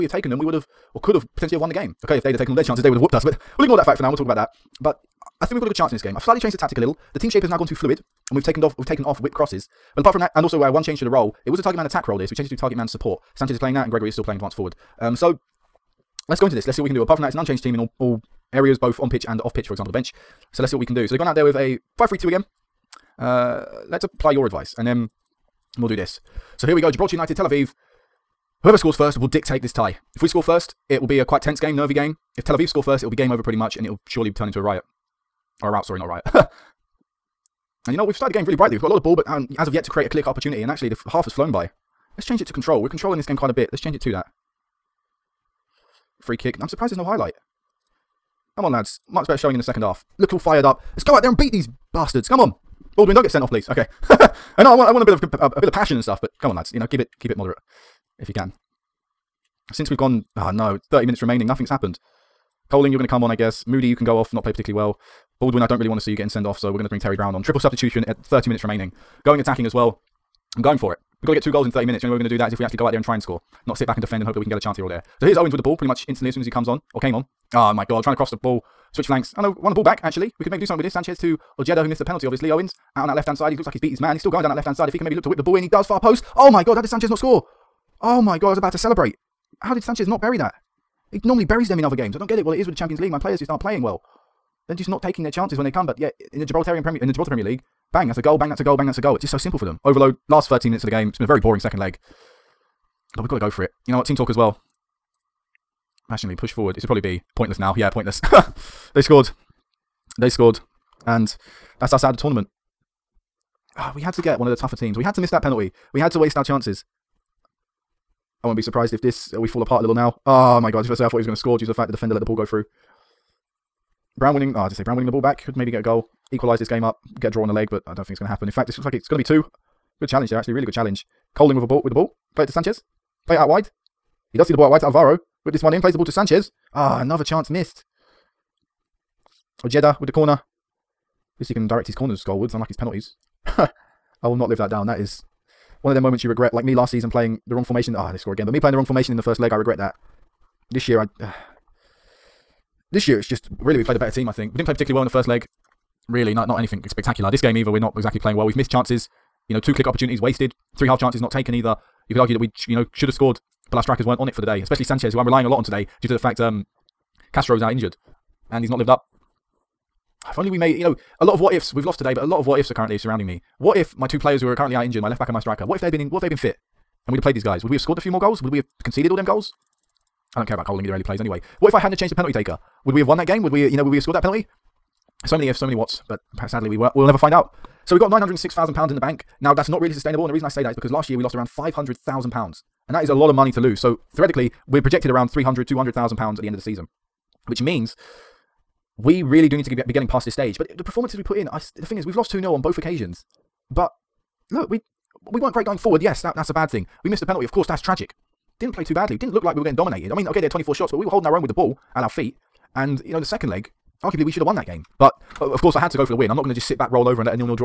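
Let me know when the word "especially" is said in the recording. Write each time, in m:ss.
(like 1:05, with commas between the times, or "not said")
2:44.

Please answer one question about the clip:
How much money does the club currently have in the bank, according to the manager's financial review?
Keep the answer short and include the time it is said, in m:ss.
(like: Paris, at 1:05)
£906,000, at 3:08.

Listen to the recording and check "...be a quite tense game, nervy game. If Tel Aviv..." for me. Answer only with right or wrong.
right.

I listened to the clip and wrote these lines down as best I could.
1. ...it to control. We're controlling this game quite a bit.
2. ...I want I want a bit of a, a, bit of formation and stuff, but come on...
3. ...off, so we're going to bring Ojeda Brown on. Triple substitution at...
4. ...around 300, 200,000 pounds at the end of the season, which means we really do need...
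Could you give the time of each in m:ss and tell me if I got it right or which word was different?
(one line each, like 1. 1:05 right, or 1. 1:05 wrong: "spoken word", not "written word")
1. 0:42 right
2. 0:54 wrong: "passion", not "formation"
3. 1:06 wrong: "Terry", not "Ojeda"
4. 3:15 right.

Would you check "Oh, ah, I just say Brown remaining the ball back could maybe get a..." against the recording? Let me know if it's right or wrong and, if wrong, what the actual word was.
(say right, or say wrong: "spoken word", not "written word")
wrong: "winning", not "remaining".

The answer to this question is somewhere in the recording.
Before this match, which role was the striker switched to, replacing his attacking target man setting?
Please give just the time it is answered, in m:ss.
0:12.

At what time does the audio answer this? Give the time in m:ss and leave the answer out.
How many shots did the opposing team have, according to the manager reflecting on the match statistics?
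3:30.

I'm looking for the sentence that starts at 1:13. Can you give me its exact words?
Not sit back and defend and hope that we can get a chance here or there.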